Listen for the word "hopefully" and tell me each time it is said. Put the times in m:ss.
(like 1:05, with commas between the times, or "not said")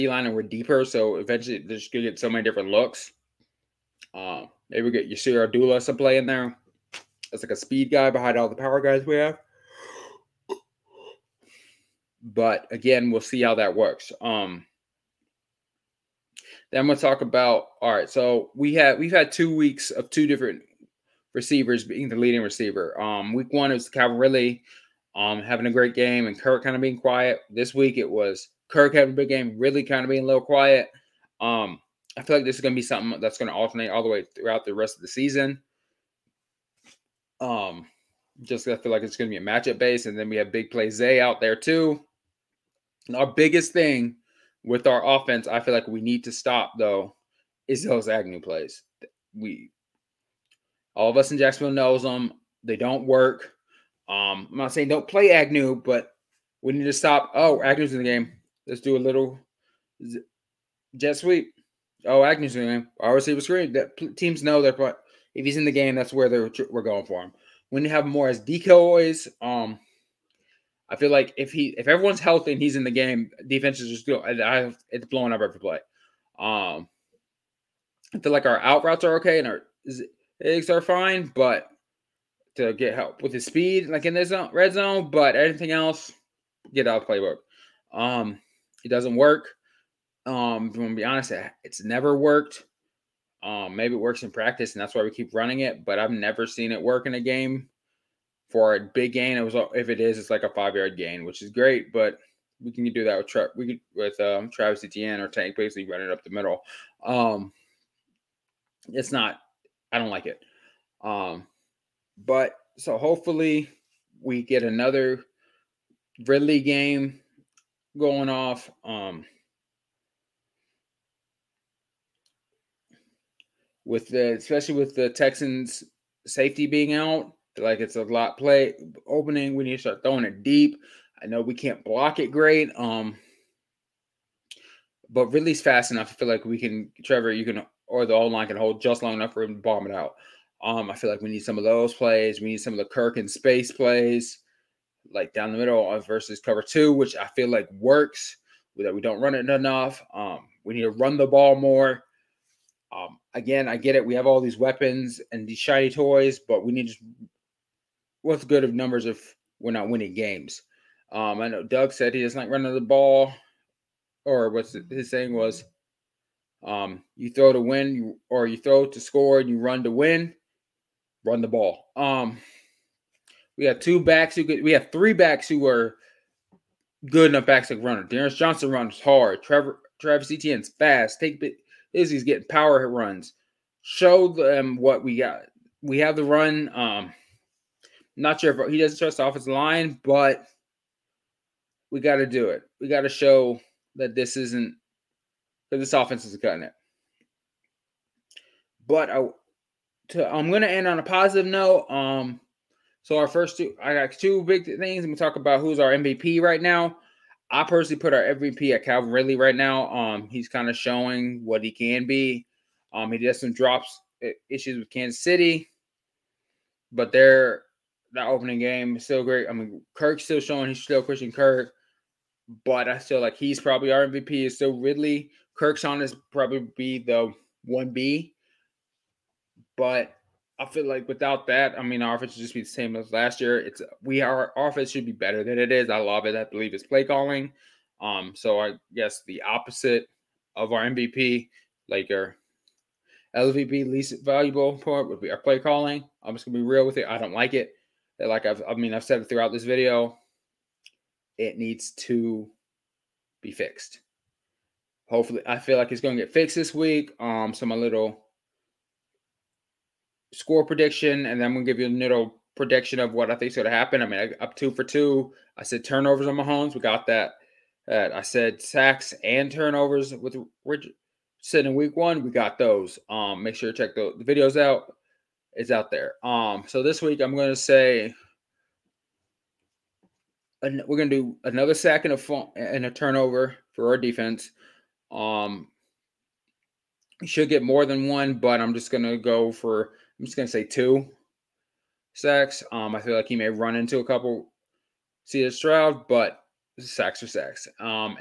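1:52, 4:15.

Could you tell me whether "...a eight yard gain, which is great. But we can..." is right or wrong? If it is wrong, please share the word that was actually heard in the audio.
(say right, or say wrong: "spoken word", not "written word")
wrong: "five", not "eight".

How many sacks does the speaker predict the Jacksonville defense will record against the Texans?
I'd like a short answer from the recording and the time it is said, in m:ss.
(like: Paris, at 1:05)
2, at 4:50.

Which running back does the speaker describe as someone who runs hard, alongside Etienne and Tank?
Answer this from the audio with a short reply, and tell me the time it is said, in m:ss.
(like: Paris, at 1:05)
D'Ernest Johnson, at 2:58.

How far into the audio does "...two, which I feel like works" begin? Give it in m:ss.
2:26.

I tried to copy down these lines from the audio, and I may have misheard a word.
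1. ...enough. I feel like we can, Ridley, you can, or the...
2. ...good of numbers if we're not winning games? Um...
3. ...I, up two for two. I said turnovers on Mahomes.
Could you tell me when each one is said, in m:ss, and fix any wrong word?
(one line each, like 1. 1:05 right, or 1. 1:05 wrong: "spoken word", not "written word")
1. 2:15 wrong: "Trevor", not "Ridley"
2. 2:38 right
3. 4:24 right.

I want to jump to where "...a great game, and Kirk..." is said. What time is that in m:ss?
0:25.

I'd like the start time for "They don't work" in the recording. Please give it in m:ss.
0:52.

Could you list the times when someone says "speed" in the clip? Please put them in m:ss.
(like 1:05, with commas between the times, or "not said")
0:07, 1:23.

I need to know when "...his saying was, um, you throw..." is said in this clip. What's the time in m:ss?
2:44.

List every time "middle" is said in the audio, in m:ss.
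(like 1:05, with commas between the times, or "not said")
1:46, 2:25.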